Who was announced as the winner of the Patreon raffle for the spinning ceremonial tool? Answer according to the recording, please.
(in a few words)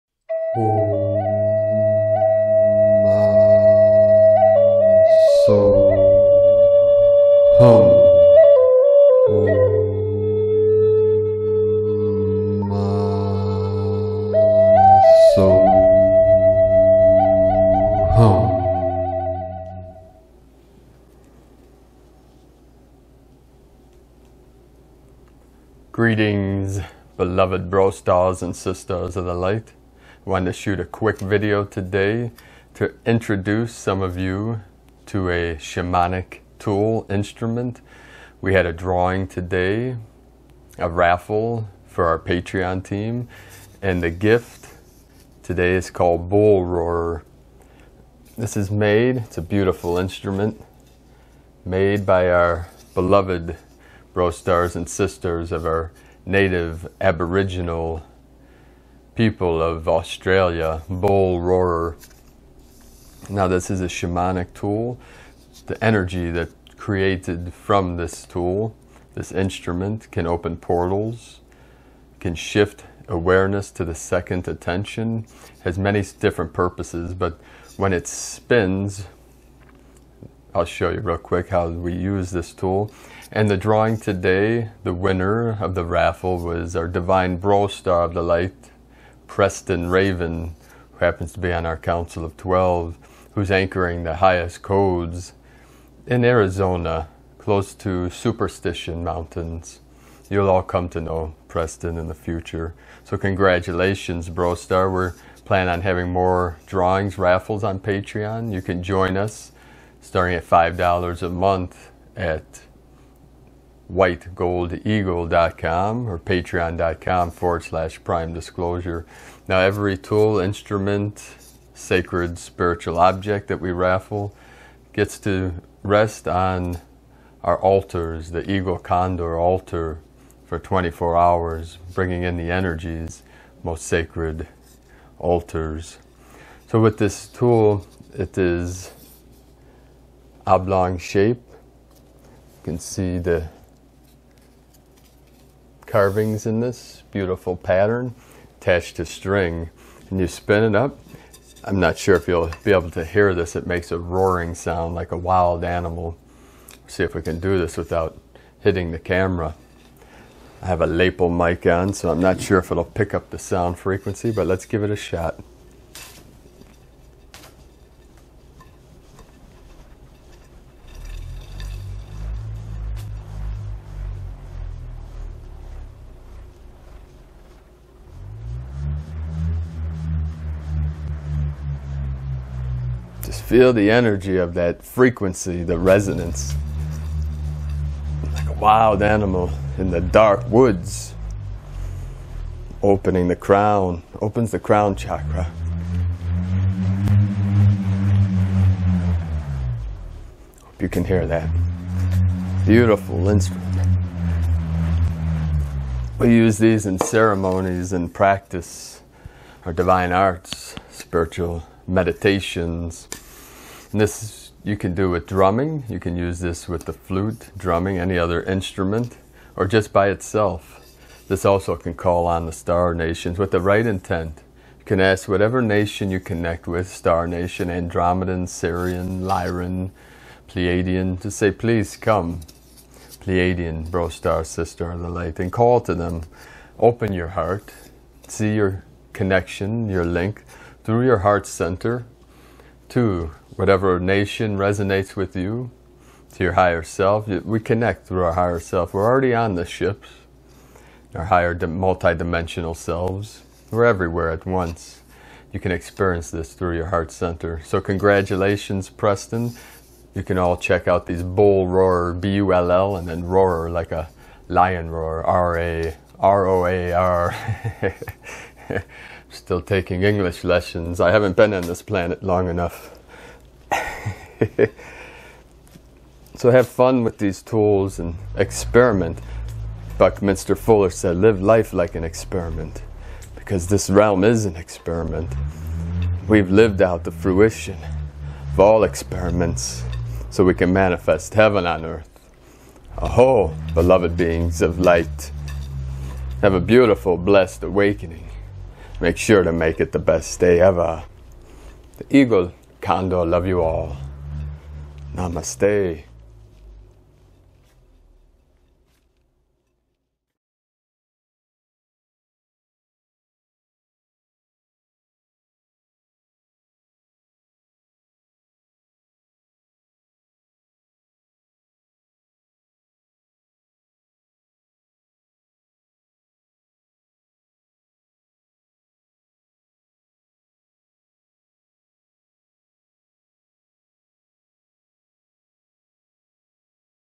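Preston Raven.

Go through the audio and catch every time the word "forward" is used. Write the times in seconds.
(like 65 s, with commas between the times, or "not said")
117 s.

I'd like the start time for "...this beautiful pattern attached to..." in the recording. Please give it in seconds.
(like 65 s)
146 s.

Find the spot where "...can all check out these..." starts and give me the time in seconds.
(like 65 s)
260 s.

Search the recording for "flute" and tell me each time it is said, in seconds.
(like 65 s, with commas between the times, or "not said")
216 s.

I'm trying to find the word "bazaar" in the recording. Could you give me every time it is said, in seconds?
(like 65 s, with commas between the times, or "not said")
not said.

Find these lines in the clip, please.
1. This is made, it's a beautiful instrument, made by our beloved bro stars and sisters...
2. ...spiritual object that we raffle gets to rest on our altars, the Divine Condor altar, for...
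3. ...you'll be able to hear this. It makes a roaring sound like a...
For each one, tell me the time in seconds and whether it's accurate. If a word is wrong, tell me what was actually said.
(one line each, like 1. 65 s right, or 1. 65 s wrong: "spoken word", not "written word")
1. 48 s right
2. 122 s wrong: "Eagle", not "Divine"
3. 152 s right.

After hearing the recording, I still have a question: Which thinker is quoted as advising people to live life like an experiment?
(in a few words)
Buckminster Fuller.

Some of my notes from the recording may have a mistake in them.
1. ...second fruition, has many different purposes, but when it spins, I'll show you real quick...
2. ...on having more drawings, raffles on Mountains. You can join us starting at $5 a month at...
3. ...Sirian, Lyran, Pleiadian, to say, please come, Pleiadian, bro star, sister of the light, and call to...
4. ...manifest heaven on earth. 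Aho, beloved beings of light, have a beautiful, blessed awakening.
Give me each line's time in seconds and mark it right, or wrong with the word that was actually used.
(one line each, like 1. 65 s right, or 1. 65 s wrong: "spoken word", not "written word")
1. 73 s wrong: "attention", not "fruition"
2. 105 s wrong: "Patreon", not "Mountains"
3. 228 s right
4. 290 s right.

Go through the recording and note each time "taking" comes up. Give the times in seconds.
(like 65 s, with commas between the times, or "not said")
269 s.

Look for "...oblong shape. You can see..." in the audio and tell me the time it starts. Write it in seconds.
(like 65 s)
140 s.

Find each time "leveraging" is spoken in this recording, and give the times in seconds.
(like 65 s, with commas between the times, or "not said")
not said.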